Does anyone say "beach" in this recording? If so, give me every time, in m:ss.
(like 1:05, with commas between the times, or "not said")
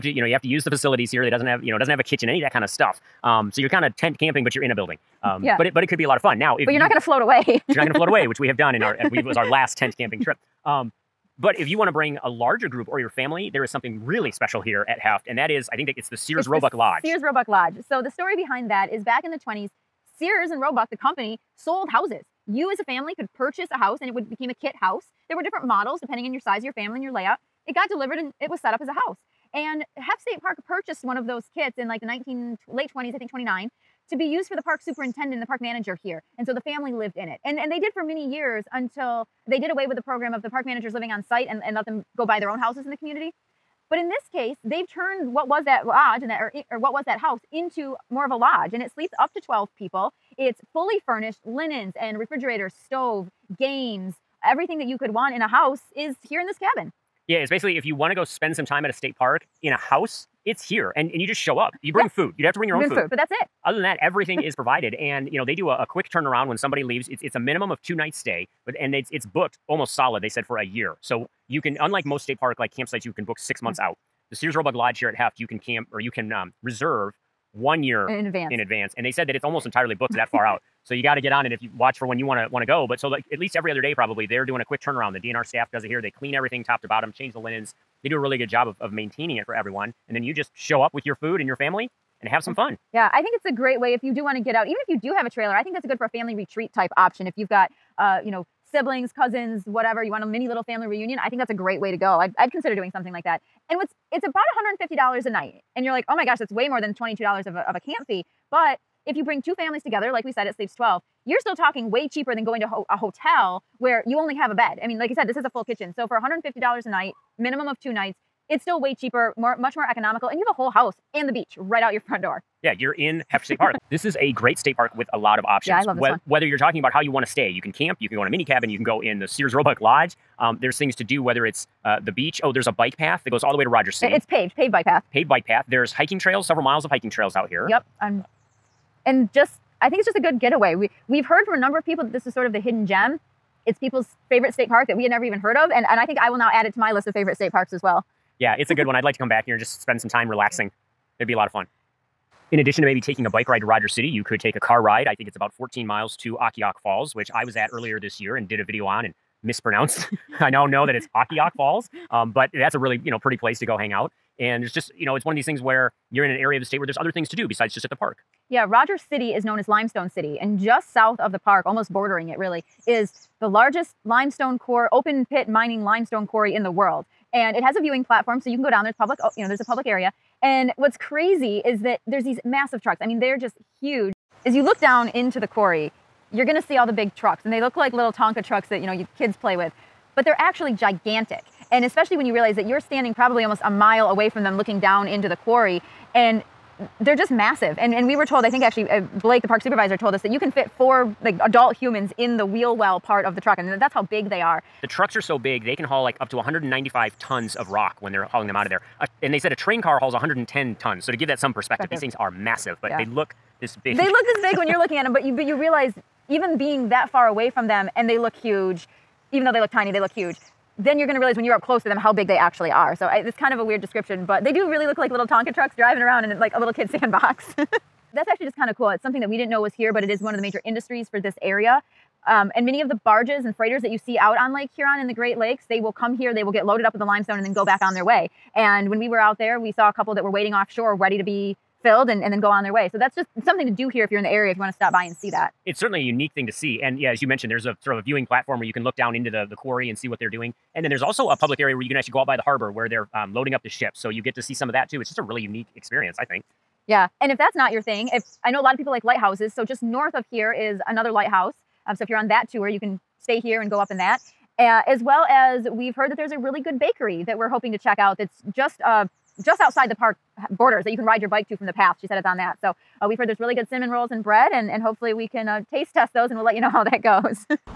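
2:01, 2:12.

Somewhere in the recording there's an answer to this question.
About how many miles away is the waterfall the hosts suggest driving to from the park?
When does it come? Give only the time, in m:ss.
2:35.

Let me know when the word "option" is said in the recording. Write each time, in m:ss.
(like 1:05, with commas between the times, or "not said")
1:36, 2:05.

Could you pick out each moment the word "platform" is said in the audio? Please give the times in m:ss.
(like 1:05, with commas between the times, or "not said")
2:58, 4:08.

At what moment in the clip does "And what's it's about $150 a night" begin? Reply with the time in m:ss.
1:43.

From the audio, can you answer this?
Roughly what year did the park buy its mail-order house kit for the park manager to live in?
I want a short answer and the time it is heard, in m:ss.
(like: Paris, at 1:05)
1929, at 0:33.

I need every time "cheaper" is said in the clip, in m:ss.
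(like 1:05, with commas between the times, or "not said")
1:52, 1:58.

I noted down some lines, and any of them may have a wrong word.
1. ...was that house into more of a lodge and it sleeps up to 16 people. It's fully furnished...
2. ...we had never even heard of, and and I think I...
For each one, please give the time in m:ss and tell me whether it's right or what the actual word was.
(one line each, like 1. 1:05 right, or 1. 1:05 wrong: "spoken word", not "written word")
1. 0:46 wrong: "12", not "16"
2. 2:24 right.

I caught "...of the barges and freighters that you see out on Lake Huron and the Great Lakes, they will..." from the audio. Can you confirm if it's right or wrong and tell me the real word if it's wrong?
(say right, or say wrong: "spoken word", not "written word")
right.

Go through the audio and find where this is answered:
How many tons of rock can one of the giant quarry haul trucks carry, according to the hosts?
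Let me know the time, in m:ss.
3:26.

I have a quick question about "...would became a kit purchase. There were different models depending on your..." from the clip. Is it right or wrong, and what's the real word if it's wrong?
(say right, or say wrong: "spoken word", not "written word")
wrong: "house", not "purchase".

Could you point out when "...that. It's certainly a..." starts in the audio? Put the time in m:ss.
4:05.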